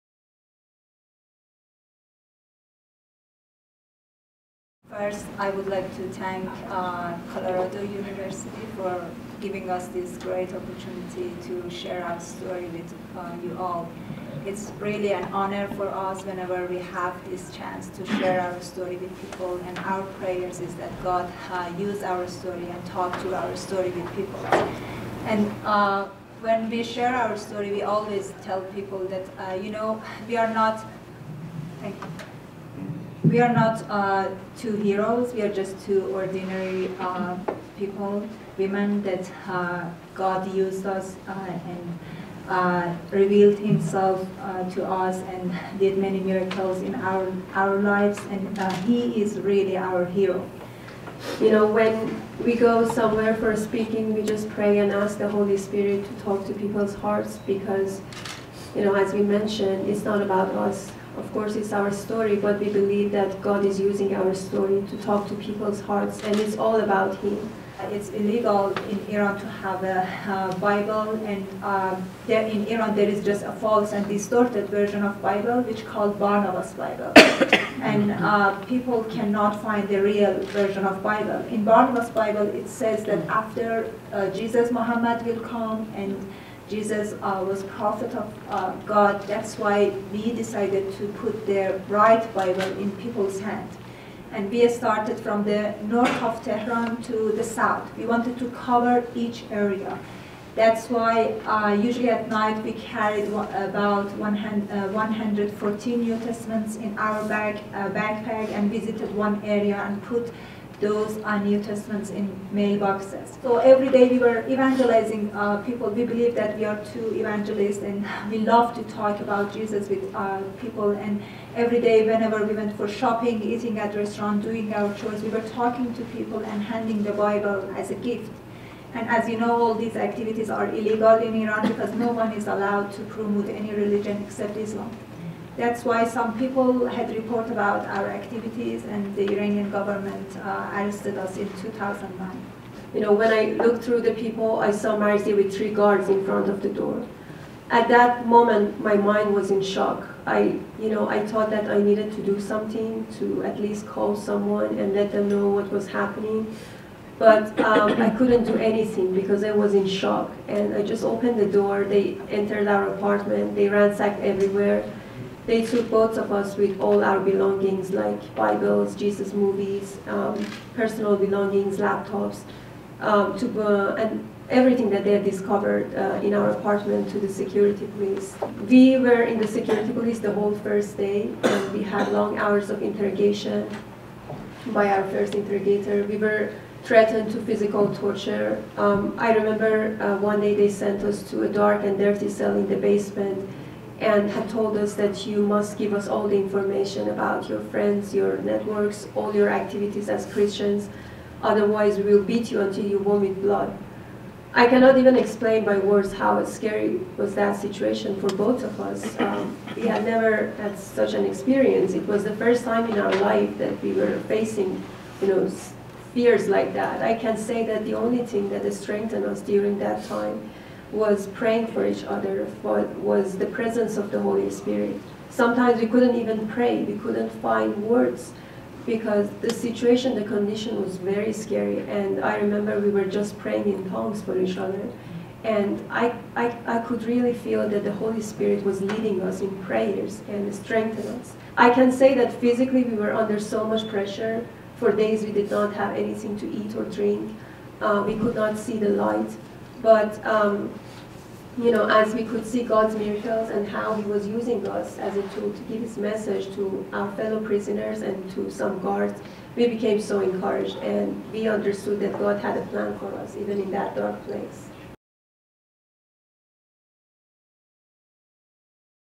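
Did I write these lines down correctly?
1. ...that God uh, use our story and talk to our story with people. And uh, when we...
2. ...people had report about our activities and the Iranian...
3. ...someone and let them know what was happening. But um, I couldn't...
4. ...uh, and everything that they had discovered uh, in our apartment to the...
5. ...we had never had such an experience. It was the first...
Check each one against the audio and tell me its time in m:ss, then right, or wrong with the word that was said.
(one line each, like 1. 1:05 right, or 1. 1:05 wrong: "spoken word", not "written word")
1. 0:20 right
2. 2:16 right
3. 2:34 right
4. 2:53 right
5. 3:29 right.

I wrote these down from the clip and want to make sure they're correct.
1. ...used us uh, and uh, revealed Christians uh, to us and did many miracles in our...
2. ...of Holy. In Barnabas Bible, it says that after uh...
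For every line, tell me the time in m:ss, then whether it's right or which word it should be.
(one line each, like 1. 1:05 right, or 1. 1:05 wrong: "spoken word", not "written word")
1. 0:40 wrong: "Himself", not "Christians"
2. 1:20 wrong: "Bible", not "Holy".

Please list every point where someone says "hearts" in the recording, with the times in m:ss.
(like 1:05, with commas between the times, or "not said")
0:56, 1:05.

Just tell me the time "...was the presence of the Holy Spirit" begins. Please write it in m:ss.
3:43.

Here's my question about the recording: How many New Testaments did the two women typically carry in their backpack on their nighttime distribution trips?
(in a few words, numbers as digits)
114.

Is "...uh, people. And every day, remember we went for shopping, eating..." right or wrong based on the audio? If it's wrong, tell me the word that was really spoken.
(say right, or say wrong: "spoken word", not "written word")
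wrong: "whenever", not "remember".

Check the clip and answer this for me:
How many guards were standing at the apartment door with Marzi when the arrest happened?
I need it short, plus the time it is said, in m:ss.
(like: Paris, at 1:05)
3, at 2:25.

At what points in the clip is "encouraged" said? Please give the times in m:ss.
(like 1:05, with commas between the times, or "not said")
4:20.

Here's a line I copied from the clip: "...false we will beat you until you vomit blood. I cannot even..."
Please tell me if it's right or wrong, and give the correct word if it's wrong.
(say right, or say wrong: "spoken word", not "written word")
wrong: "otherwise", not "false".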